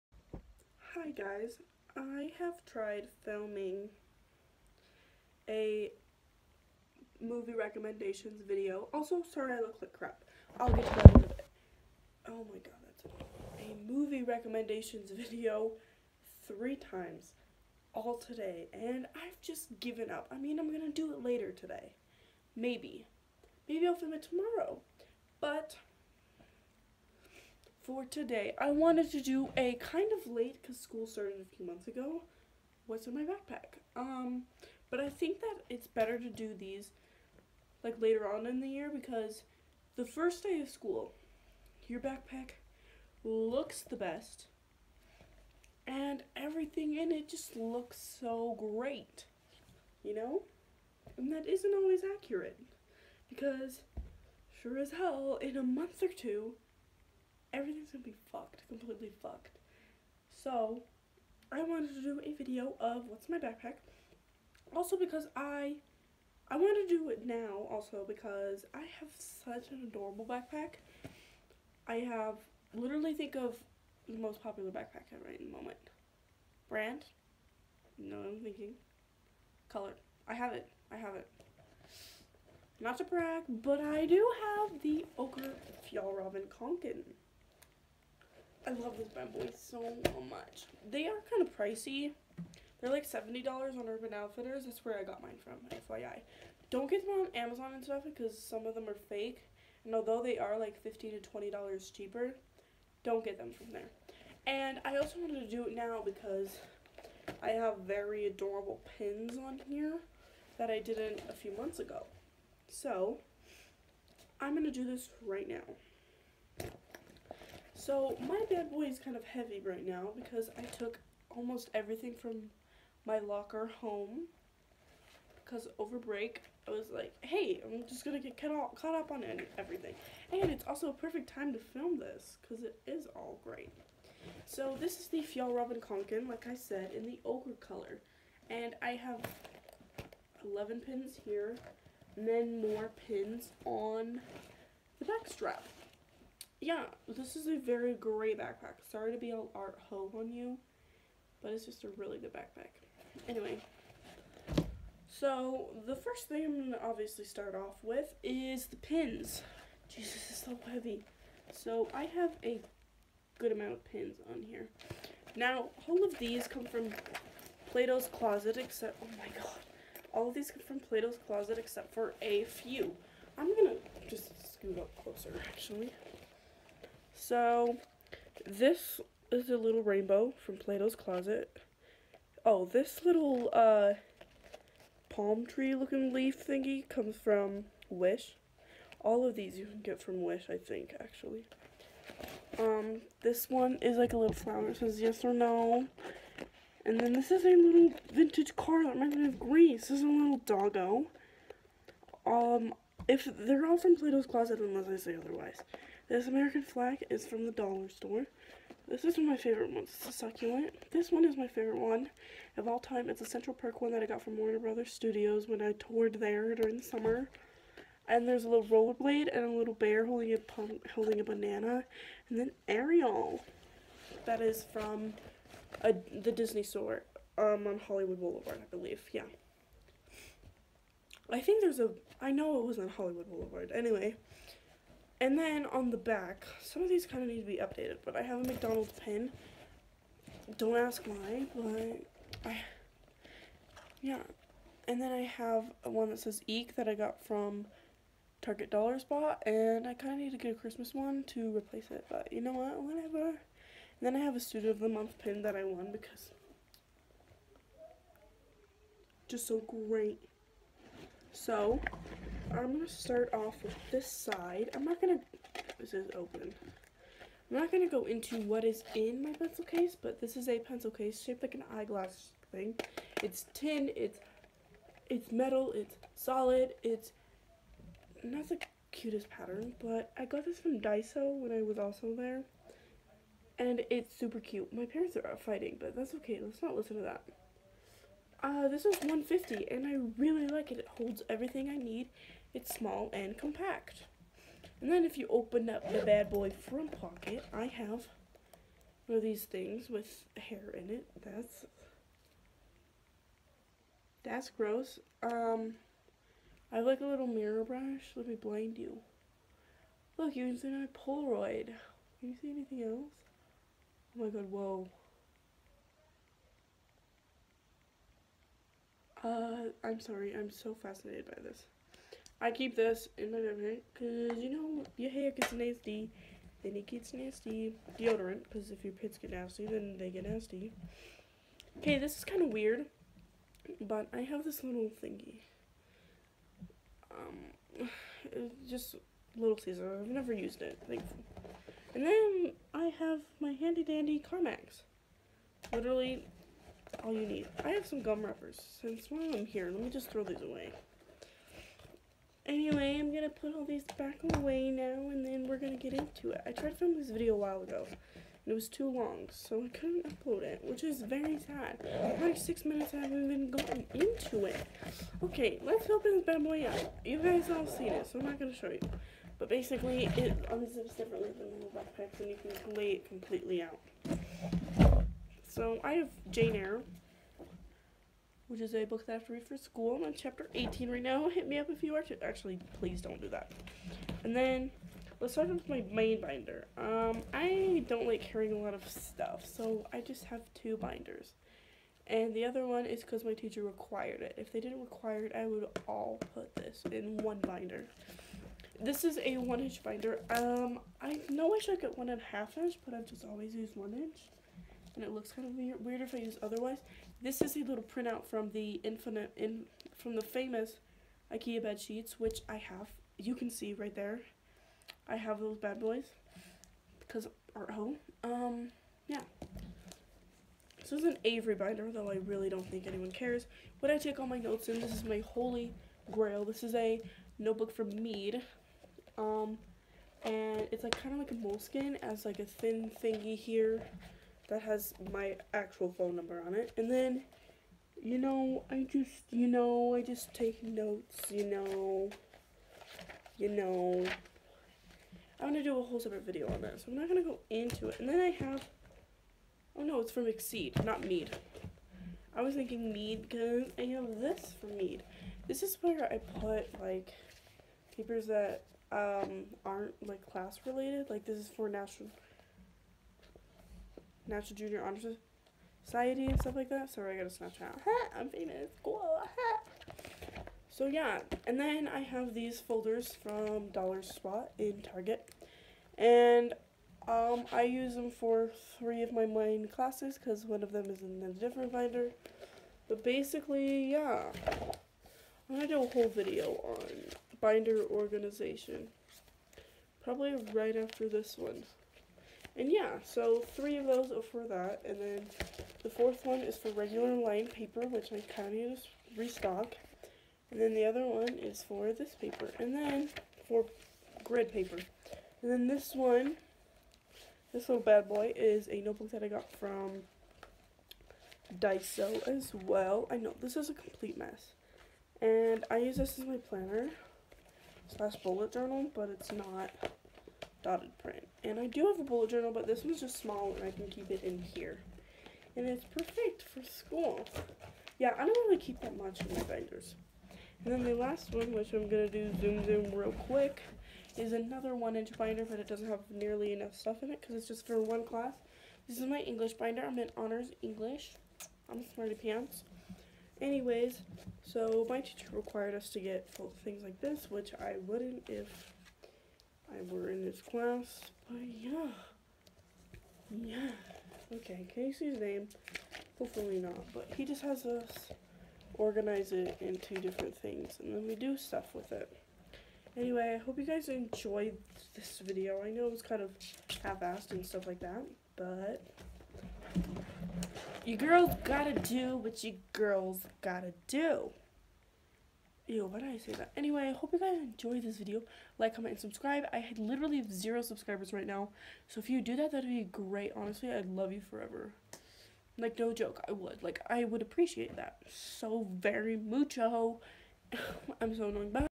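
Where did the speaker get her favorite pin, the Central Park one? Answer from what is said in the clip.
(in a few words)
Warner Brothers Studios.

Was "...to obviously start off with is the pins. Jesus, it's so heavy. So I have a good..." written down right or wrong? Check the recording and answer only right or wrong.
right.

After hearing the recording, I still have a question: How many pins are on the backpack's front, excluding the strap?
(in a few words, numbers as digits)
11.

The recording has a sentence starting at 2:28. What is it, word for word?
Sorry to be all art ho on you, but it's just a really good backpack.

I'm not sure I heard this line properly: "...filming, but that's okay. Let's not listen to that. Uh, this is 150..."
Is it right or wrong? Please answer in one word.
wrong.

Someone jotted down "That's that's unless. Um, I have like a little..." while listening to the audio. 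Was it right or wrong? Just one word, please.
wrong.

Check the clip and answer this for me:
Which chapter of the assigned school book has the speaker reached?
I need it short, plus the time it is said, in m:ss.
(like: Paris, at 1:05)
18, at 6:20.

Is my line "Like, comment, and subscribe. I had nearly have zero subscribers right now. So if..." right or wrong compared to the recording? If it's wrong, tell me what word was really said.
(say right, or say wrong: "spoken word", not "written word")
wrong: "literally", not "nearly".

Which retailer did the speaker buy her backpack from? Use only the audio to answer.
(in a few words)
Urban Outfitters.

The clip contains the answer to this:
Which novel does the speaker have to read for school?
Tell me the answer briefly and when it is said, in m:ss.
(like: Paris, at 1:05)
Jane Eyre, at 6:16.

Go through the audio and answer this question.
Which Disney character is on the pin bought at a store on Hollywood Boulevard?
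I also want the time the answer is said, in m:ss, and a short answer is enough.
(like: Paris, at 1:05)
Ariel, at 3:42.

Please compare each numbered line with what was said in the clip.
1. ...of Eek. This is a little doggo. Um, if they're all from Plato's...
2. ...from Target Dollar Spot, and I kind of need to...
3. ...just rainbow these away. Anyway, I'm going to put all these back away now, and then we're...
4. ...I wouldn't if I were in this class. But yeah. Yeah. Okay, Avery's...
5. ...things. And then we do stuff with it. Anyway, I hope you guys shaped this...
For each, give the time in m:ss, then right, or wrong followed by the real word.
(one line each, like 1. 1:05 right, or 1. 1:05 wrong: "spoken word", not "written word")
1. 3:19 wrong: "Grease", not "Eek"
2. 4:07 right
3. 5:49 wrong: "throw", not "rainbow"
4. 9:07 wrong: "Casey", not "Avery"
5. 9:20 wrong: "enjoyed", not "shaped".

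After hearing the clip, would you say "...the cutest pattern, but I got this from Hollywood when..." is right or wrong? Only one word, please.
wrong.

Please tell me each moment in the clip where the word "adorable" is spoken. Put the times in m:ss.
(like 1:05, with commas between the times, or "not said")
1:09, 1:48.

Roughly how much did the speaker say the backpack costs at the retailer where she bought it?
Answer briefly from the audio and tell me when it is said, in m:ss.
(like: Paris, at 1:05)
$70, at 1:33.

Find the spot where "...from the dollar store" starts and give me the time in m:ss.
3:27.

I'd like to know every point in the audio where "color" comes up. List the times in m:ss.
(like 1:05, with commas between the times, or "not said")
1:19, 2:17.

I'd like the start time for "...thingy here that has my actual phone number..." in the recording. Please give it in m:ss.
7:13.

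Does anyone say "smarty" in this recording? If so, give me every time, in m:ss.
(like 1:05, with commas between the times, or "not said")
9:01.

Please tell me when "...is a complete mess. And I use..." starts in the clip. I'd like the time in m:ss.
8:33.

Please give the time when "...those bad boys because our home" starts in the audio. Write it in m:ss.
6:55.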